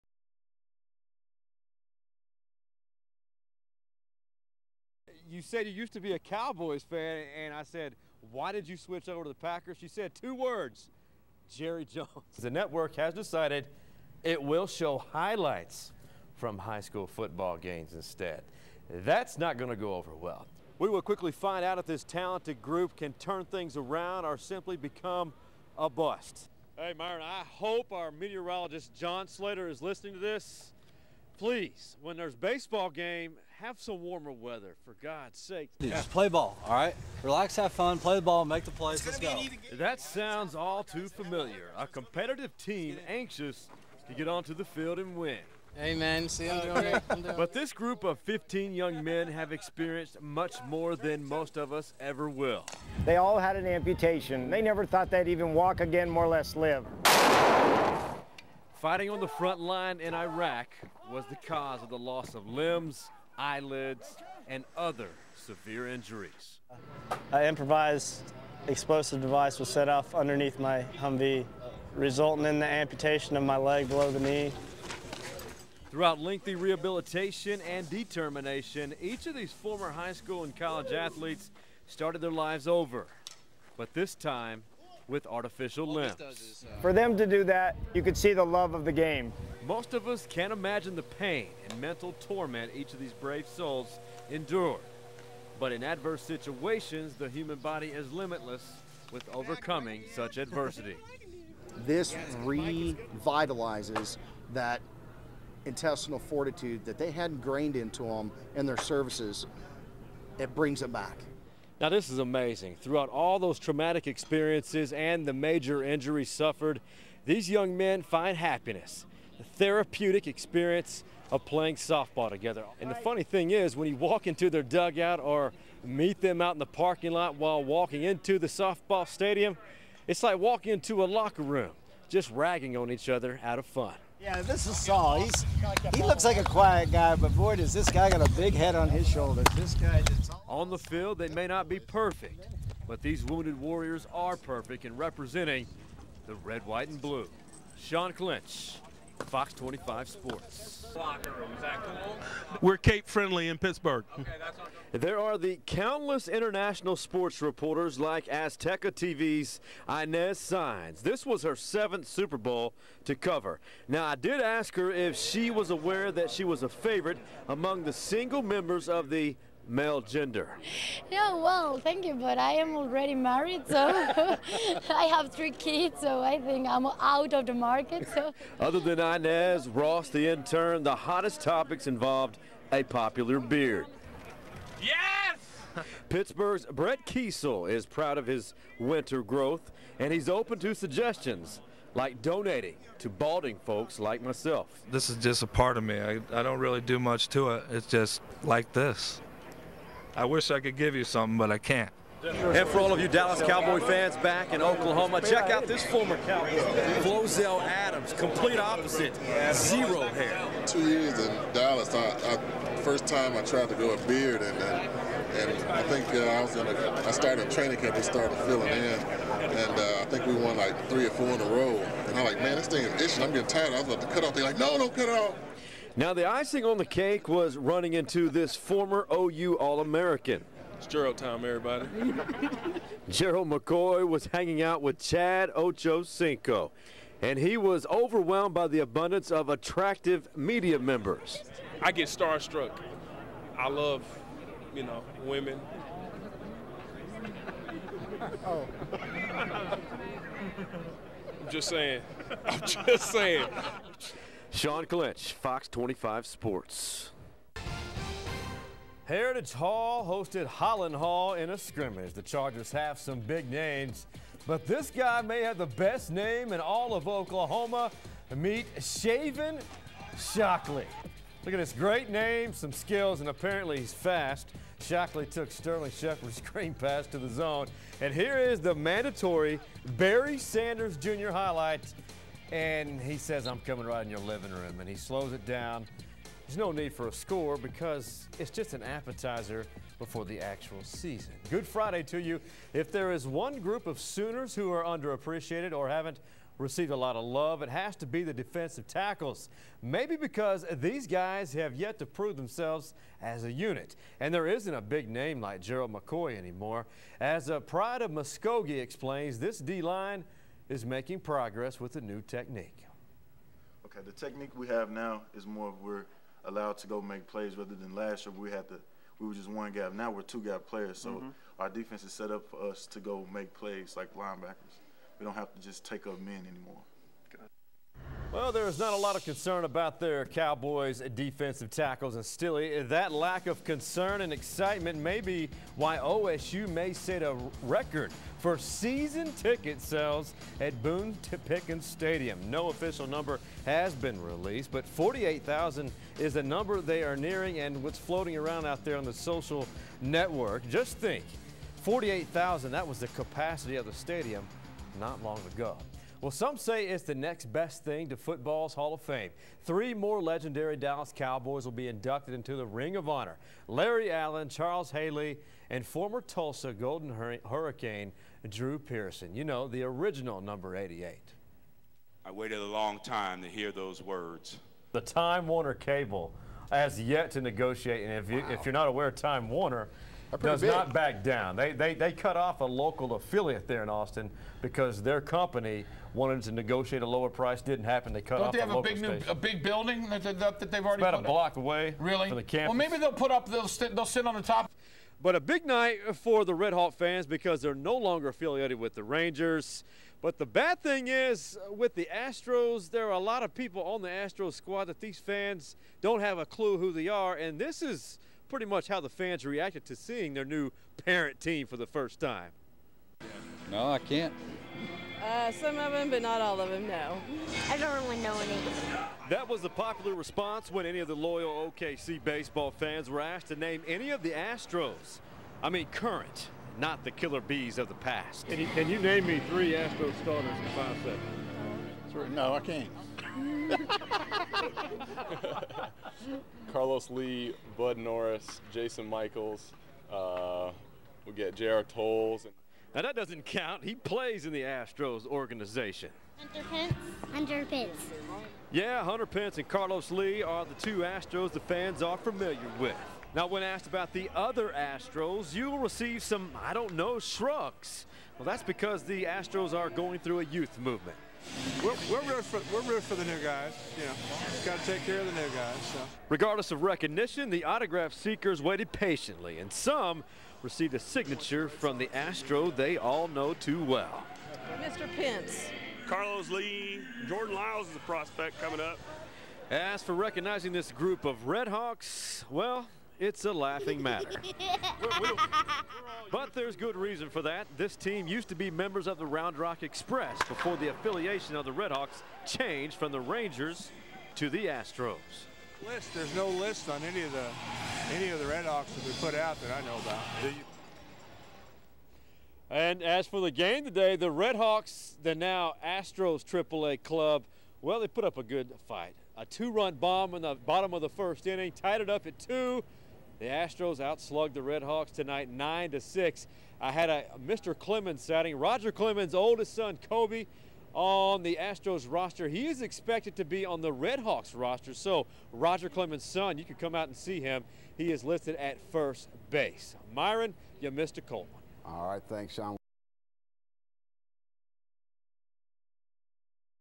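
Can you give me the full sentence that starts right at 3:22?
And for all of you Dallas Cowboy fans back in Oklahoma, check out this former Cowboy, Flozell Adams, complete opposite, zero hair.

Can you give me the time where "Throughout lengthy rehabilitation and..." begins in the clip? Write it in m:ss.
1:15.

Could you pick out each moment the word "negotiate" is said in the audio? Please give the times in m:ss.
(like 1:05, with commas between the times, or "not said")
6:17, 6:26.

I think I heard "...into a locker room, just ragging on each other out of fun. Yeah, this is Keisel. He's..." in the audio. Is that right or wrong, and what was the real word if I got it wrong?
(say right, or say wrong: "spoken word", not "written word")
wrong: "Saul", not "Keisel".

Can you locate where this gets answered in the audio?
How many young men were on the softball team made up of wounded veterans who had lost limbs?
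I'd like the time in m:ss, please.
0:48.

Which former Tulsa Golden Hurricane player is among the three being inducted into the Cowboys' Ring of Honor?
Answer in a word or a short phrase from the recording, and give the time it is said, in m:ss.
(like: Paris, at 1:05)
Drew Pearson, at 6:08.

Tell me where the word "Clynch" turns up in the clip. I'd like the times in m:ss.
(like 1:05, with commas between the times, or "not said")
2:28, 4:14.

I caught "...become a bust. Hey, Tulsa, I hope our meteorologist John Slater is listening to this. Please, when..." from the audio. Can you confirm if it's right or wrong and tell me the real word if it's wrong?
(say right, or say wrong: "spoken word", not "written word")
wrong: "Myron", not "Tulsa".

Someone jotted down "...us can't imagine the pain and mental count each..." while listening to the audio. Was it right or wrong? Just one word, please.
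wrong.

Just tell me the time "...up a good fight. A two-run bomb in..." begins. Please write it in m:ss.
8:28.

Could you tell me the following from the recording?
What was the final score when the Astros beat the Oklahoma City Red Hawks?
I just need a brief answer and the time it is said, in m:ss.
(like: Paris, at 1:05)
9 to 6, at 8:35.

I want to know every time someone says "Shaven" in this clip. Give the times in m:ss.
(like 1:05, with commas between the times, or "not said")
4:28.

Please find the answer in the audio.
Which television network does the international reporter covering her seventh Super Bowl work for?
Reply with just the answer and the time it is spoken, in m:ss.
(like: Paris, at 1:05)
Azteca TV, at 2:38.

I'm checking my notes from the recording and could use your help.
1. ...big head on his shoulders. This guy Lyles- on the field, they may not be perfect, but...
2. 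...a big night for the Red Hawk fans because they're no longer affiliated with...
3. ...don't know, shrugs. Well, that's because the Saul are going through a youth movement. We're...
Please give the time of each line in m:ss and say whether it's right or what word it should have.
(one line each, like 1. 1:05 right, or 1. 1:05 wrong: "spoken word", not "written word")
1. 2:18 wrong: "All", not "Lyles"
2. 6:35 right
3. 7:36 wrong: "Astros", not "Saul".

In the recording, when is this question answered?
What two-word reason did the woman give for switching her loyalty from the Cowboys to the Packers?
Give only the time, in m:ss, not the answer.
0:11.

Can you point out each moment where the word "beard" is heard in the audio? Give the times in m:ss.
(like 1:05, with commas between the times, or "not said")
3:03, 3:34.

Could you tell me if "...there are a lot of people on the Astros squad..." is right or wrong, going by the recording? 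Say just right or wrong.
right.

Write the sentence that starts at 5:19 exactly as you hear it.
Now we're two gap players, so mm -hmm.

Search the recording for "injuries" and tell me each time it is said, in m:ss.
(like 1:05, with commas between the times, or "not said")
1:05, 1:55.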